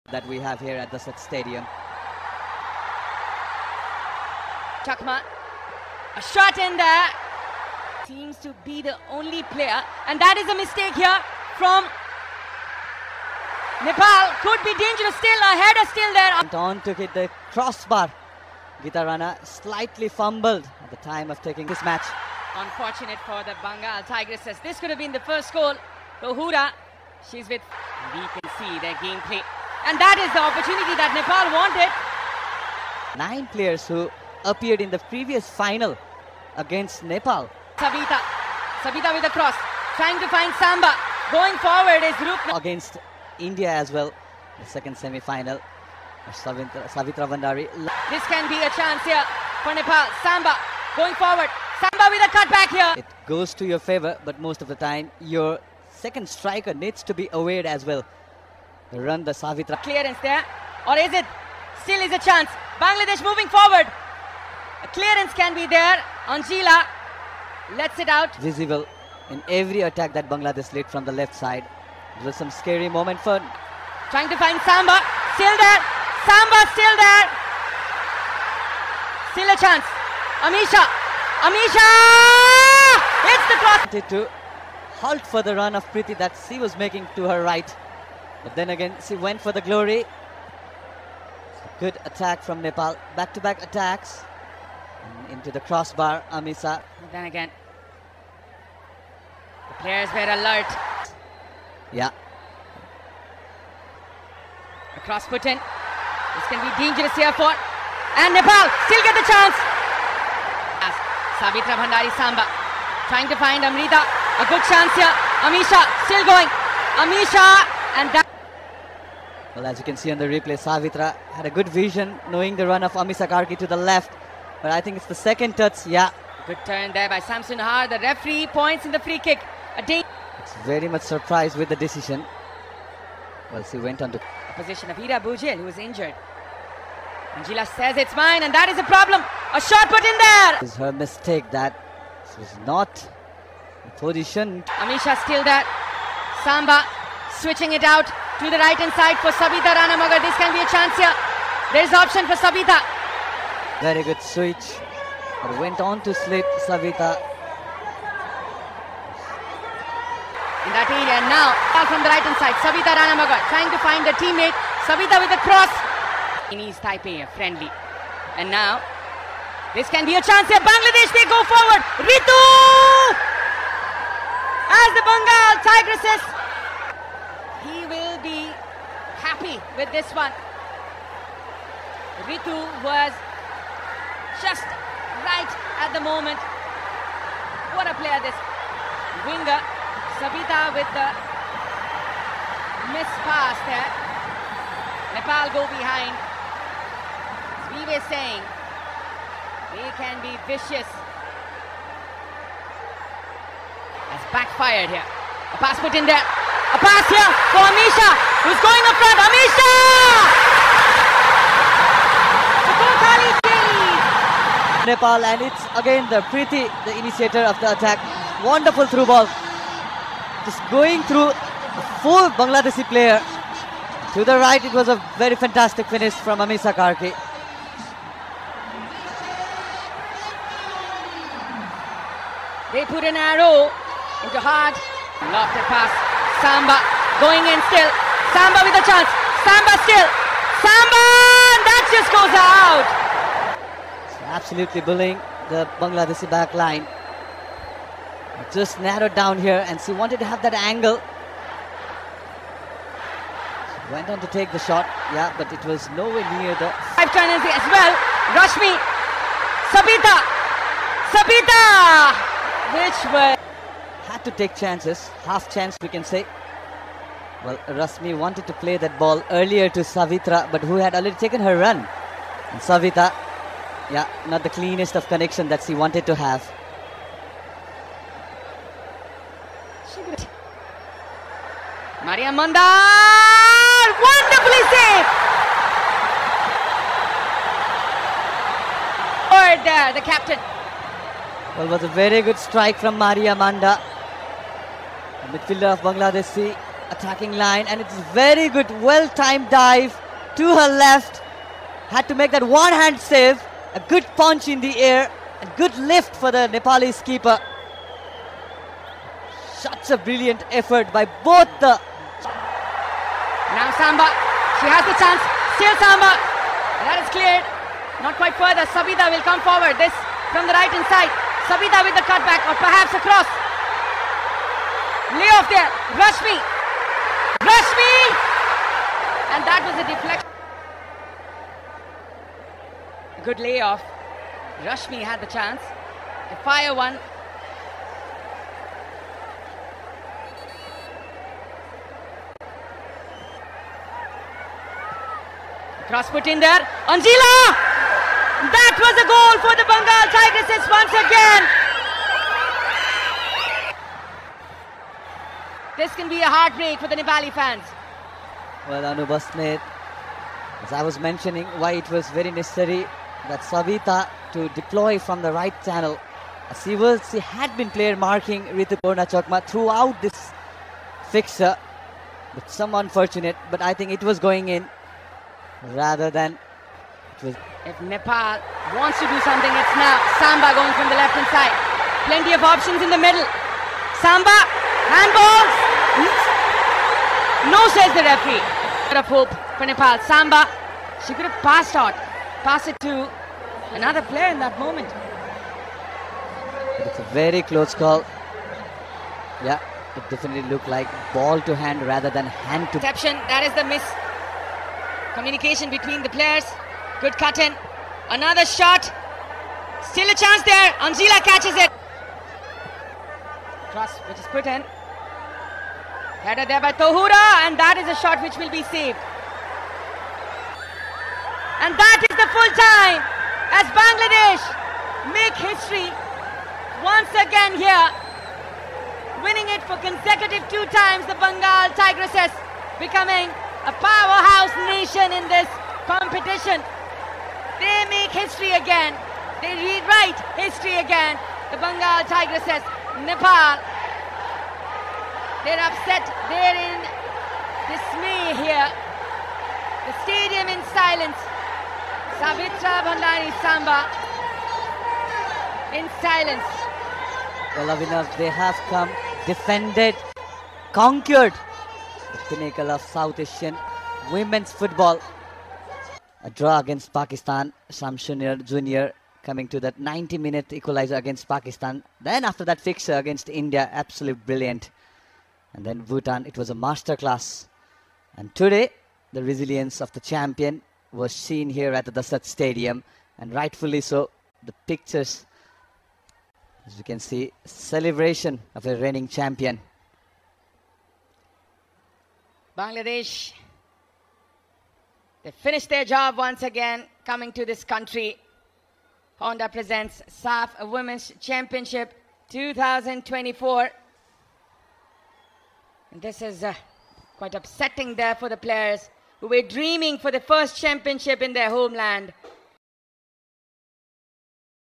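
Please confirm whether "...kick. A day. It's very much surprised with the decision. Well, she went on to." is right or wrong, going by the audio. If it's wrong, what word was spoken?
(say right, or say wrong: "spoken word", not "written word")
right.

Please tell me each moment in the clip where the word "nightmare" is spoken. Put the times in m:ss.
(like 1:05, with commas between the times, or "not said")
not said.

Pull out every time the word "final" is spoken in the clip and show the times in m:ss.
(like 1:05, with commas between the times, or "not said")
0:35, 0:44.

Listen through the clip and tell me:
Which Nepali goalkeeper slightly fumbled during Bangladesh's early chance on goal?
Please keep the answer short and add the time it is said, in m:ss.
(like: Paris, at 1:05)
Gita Rana, at 0:18.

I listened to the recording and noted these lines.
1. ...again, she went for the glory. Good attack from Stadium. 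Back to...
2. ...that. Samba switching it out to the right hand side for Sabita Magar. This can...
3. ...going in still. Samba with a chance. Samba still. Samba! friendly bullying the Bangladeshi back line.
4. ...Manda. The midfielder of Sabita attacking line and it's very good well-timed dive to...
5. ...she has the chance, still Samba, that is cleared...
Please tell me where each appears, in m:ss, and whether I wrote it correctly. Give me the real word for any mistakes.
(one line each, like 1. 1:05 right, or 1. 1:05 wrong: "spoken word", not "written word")
1. 1:28 wrong: "Nepal", not "Stadium"
2. 2:25 right
3. 3:57 wrong: "absolutely", not "friendly"
4. 4:53 wrong: "Bangladeshi", not "Sabita"
5. 5:14 right.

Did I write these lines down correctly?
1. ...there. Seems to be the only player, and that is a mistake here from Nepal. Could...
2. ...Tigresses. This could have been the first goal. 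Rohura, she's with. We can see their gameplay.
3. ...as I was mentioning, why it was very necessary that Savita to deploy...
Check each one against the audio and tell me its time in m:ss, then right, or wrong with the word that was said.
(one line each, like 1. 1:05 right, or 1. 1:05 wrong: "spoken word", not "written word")
1. 0:06 right
2. 0:24 right
3. 6:00 right.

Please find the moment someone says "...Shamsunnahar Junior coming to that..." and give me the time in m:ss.
7:47.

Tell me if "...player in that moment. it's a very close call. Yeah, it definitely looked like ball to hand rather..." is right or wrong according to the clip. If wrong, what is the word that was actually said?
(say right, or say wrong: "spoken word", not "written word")
right.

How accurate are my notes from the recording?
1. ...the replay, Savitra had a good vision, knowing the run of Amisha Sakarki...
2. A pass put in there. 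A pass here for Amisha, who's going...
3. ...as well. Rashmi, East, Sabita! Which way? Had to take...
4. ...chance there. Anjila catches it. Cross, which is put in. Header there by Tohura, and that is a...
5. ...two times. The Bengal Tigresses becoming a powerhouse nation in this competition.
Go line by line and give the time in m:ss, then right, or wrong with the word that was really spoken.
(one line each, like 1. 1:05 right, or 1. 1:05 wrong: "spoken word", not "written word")
1. 2:00 right
2. 3:25 right
3. 4:17 wrong: "Sabita", not "East"
4. 6:50 right
5. 7:10 right.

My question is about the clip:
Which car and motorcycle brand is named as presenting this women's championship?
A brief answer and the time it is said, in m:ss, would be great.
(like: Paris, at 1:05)
Honda, at 8:19.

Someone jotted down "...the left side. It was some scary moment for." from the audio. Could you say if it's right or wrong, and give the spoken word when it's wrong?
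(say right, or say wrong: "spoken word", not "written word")
right.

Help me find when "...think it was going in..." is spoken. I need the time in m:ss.
6:13.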